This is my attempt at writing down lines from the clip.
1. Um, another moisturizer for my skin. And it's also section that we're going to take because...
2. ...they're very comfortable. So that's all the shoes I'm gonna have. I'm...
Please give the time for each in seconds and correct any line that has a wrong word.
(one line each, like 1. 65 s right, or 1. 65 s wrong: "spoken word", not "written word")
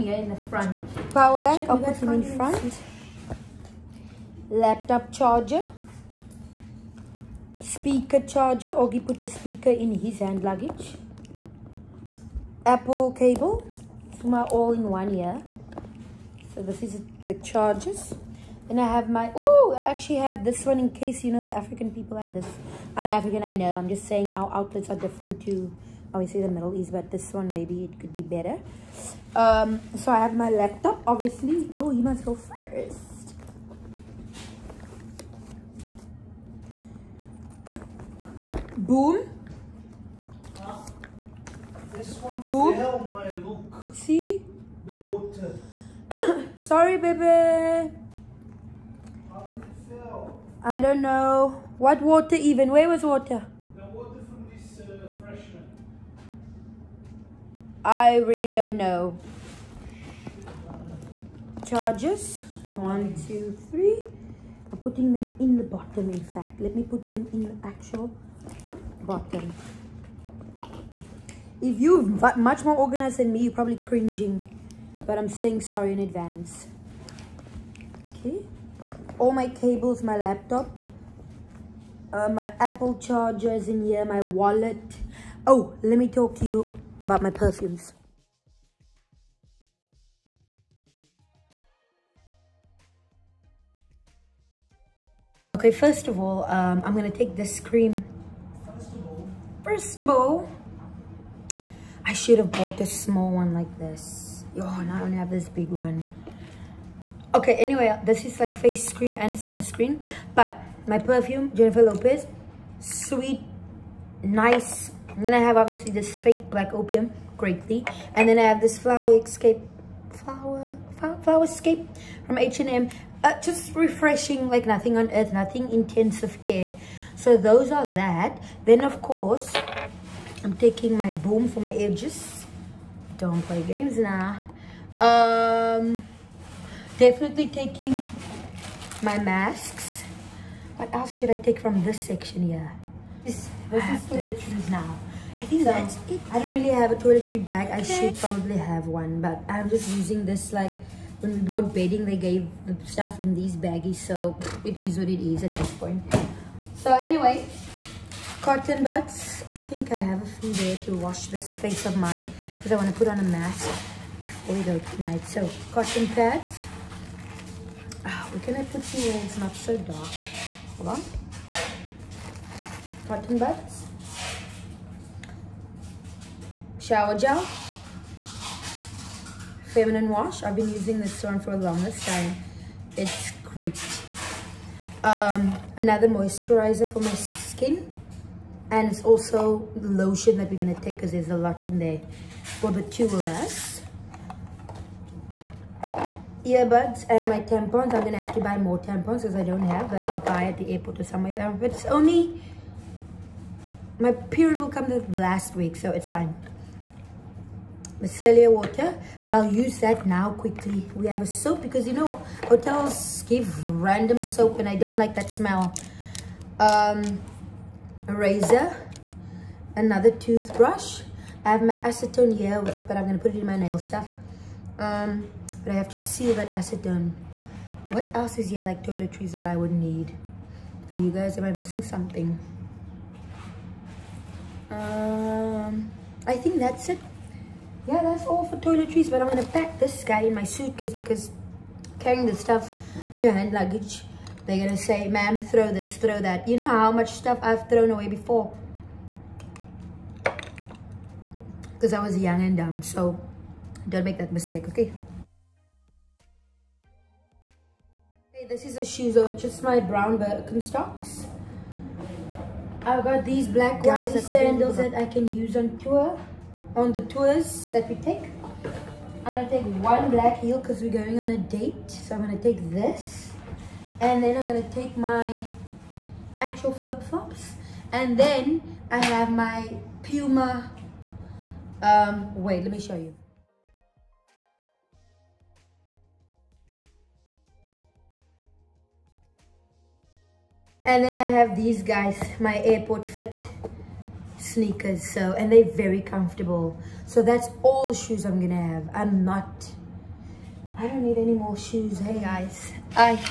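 1. 185 s wrong: "lotion", not "section"
2. 295 s right.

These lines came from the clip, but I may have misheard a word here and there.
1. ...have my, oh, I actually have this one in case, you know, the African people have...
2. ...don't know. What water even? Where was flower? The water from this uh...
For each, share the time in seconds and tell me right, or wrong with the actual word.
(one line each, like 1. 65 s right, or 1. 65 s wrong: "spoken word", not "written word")
1. 18 s right
2. 50 s wrong: "water", not "flower".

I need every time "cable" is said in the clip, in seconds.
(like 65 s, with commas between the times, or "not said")
13 s, 79 s.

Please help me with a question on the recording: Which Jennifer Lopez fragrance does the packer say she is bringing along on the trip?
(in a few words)
Sweet Nice.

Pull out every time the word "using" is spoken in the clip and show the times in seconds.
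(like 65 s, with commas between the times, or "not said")
149 s, 180 s.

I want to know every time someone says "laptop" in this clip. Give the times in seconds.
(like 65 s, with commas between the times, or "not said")
4 s, 30 s, 80 s.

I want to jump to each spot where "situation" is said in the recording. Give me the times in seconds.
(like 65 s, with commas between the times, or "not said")
not said.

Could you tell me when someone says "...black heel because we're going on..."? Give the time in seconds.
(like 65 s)
270 s.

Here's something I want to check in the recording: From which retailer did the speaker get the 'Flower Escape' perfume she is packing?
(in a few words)
H&M.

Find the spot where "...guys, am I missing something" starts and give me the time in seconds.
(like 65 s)
231 s.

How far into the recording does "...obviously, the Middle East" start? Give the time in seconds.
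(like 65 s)
26 s.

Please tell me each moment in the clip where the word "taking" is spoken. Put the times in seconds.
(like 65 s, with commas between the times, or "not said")
130 s, 137 s.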